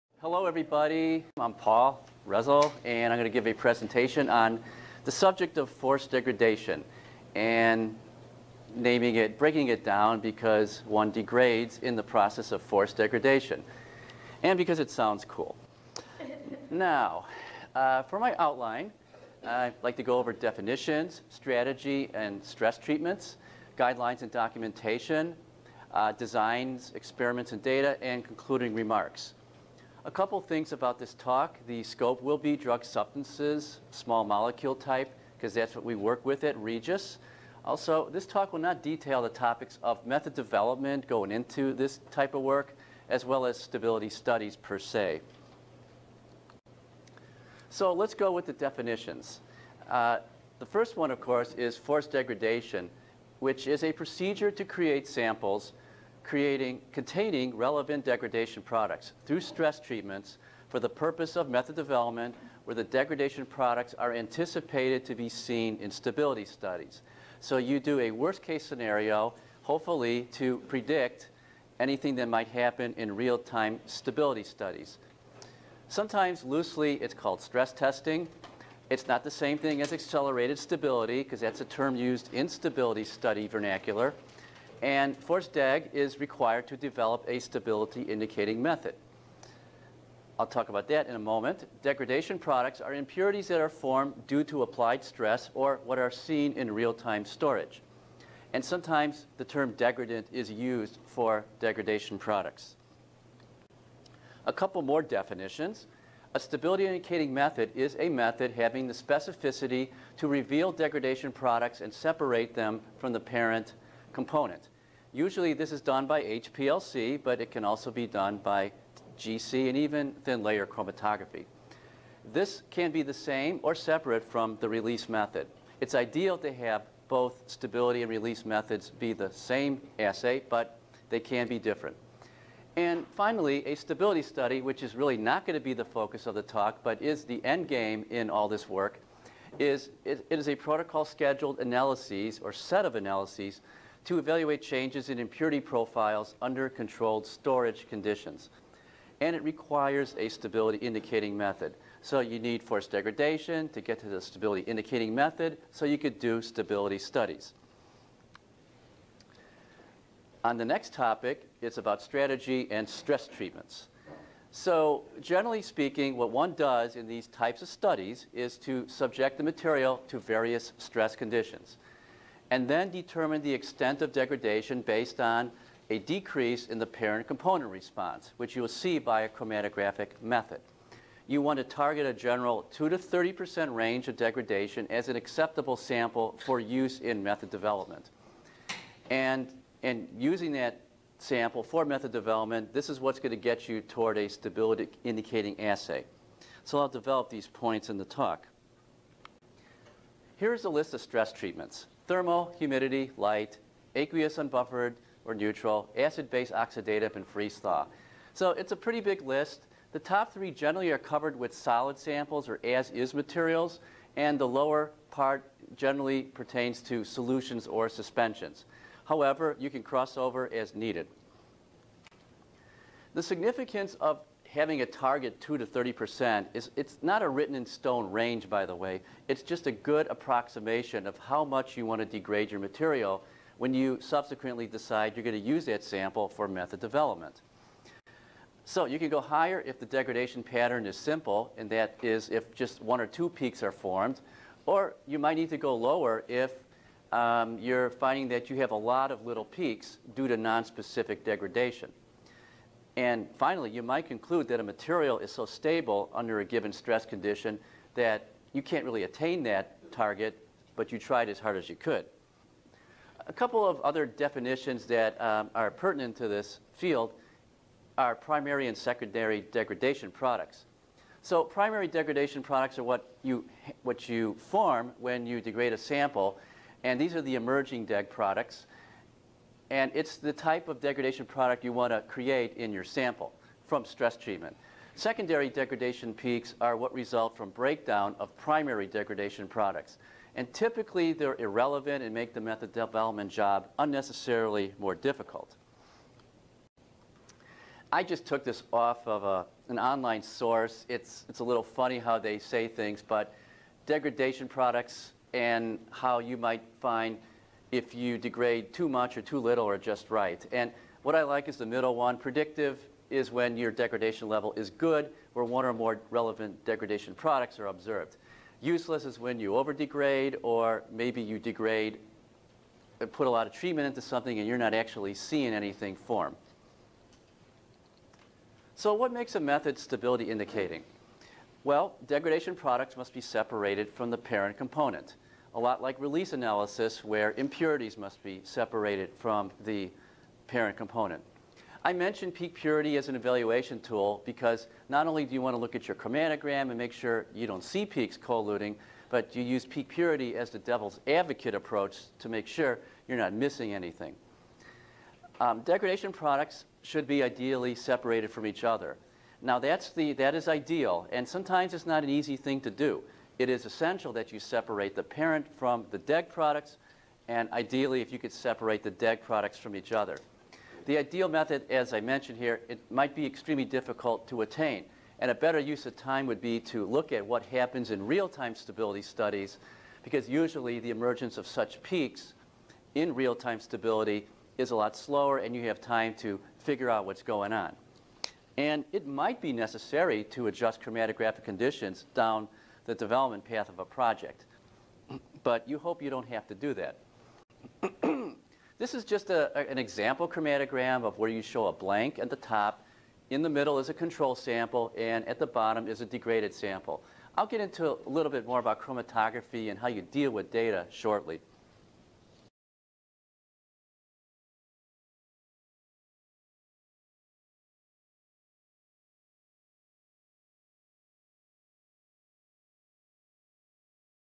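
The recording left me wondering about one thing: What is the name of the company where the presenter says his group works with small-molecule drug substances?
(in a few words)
Regis.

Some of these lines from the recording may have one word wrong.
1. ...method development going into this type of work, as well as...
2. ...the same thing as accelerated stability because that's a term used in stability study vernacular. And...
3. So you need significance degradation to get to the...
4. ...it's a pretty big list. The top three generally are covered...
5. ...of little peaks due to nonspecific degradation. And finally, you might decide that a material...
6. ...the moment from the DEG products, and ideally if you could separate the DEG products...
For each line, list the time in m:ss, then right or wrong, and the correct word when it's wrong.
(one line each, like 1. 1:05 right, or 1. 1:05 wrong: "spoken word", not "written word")
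1. 0:40 right
2. 1:19 right
3. 2:32 wrong: "force", not "significance"
4. 3:28 right
5. 4:09 wrong: "conclude", not "decide"
6. 6:04 wrong: "parent", not "moment".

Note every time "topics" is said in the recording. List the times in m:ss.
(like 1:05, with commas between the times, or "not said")
0:39, 2:40.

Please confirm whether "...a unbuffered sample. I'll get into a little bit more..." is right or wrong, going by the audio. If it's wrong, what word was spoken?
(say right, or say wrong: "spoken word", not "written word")
wrong: "degraded", not "unbuffered".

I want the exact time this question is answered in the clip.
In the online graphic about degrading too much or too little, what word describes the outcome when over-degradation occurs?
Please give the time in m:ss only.
5:18.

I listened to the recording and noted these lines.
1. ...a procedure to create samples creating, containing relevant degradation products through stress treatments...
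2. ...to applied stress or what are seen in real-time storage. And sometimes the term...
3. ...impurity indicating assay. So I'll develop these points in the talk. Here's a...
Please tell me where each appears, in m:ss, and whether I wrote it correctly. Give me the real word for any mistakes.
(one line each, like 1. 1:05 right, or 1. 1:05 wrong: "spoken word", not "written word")
1. 0:53 right
2. 1:34 right
3. 3:14 wrong: "stability", not "impurity".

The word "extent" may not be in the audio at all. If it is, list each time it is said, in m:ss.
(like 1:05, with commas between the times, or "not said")
2:53.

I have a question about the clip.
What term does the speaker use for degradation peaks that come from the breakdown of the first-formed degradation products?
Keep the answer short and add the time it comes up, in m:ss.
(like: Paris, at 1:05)
Secondary degradation peaks, at 4:44.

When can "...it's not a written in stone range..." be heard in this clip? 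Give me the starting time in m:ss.
3:46.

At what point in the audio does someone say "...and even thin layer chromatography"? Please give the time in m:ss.
1:59.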